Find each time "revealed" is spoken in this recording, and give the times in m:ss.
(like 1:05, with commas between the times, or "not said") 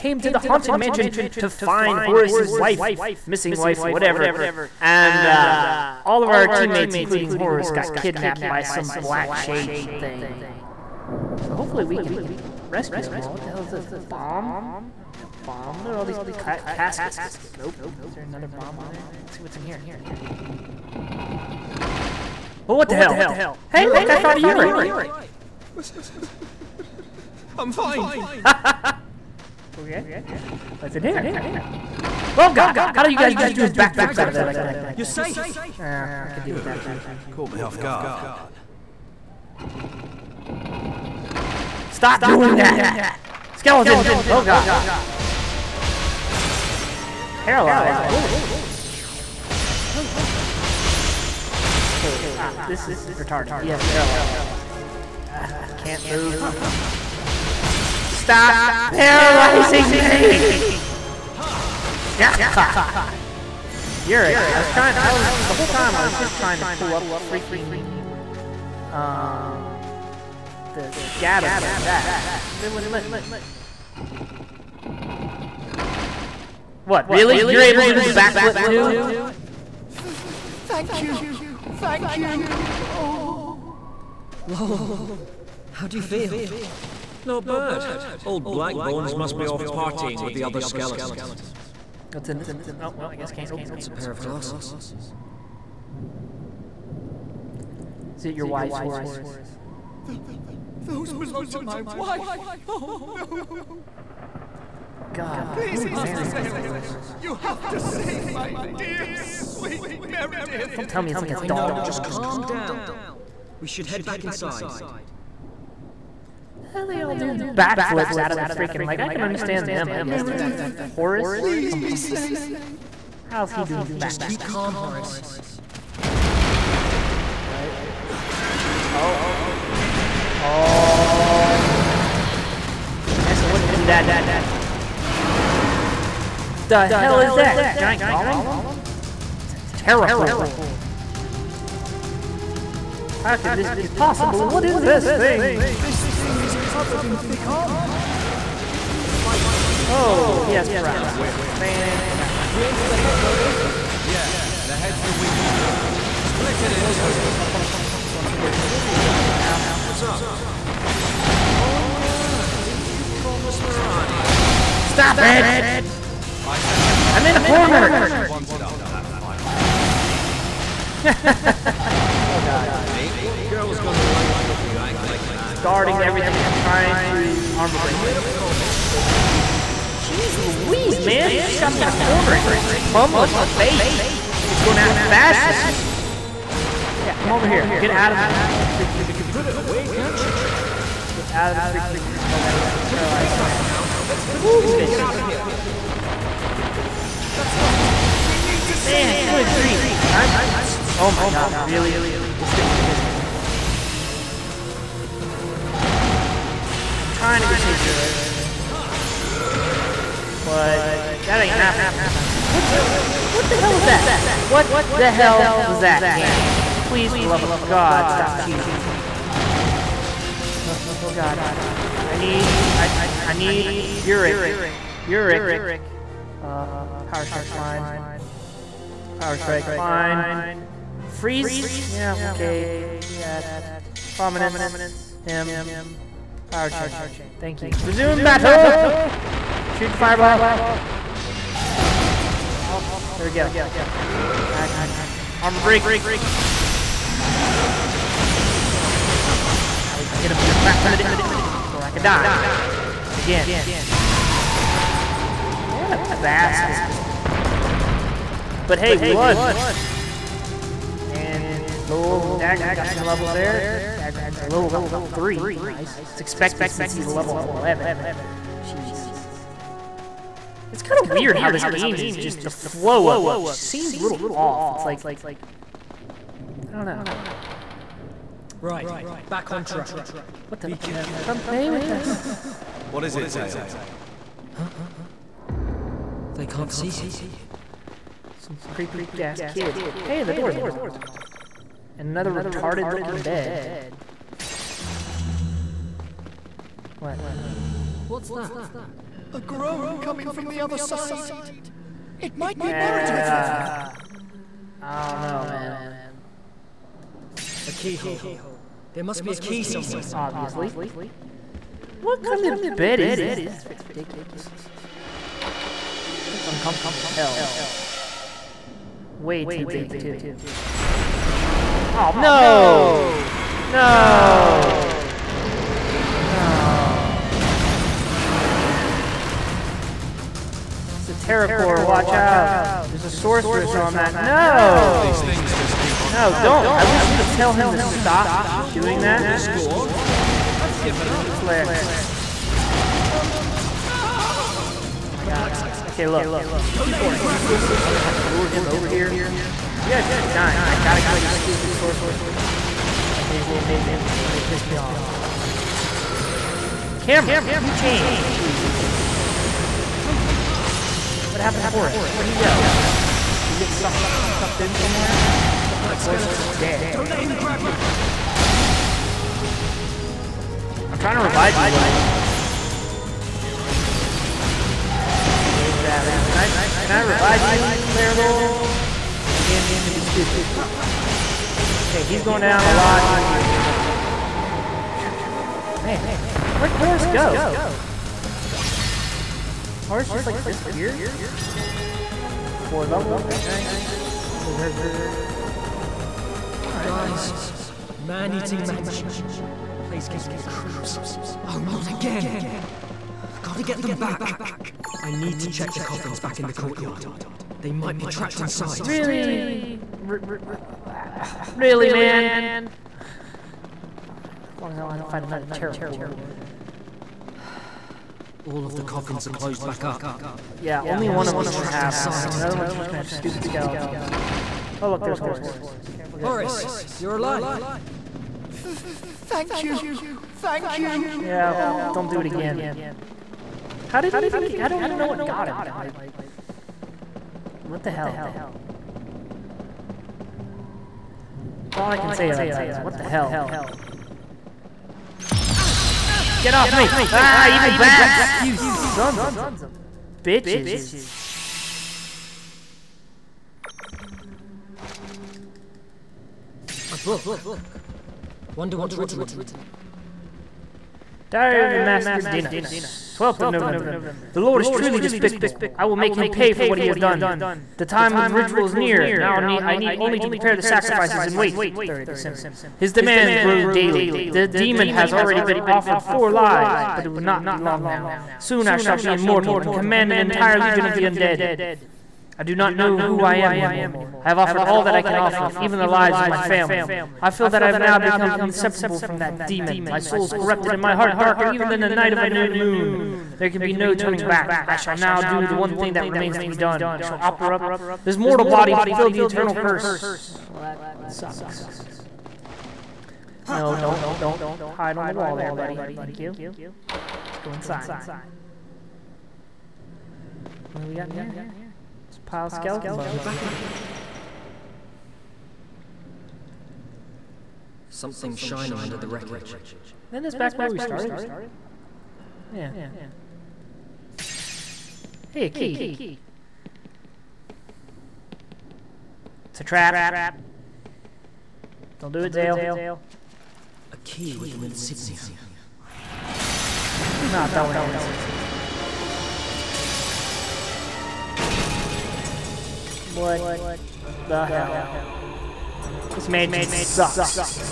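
not said.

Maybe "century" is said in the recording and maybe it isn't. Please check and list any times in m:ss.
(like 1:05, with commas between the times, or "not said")
not said.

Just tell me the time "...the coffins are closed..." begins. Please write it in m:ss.
6:58.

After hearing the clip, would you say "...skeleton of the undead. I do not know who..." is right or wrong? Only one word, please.
wrong.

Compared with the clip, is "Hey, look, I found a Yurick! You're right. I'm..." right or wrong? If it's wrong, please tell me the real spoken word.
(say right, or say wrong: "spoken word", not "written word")
right.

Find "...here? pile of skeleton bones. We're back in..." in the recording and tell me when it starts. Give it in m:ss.
8:31.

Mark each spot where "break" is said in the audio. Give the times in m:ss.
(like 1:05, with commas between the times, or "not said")
2:57, 4:05.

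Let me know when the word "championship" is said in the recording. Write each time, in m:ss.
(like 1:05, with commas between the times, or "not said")
not said.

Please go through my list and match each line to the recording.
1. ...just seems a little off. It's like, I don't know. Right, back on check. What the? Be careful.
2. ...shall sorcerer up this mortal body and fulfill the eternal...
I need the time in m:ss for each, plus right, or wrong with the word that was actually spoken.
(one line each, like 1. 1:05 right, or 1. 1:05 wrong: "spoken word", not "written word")
1. 4:33 wrong: "track", not "check"
2. 8:17 wrong: "offer", not "sorcerer".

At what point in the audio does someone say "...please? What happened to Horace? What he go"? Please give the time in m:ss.
5:58.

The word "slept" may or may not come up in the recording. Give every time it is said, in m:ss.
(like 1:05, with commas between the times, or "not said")
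not said.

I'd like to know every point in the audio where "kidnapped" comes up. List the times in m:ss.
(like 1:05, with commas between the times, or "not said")
0:07.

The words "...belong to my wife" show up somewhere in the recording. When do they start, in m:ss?
1:41.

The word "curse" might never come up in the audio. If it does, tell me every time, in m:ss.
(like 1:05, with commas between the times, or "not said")
8:19.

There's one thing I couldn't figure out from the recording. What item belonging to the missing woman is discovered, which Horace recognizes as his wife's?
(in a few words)
A pair of glasses.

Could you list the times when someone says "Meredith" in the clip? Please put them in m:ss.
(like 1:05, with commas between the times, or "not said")
1:50, 2:00, 5:02.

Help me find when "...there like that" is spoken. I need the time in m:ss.
0:34.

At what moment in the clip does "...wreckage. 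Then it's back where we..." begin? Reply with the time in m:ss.
8:39.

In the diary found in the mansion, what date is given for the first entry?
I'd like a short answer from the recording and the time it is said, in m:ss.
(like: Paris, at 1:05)
12 November, at 7:43.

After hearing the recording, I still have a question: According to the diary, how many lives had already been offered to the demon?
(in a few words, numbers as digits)
4.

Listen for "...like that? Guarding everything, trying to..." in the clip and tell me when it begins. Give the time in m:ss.
2:55.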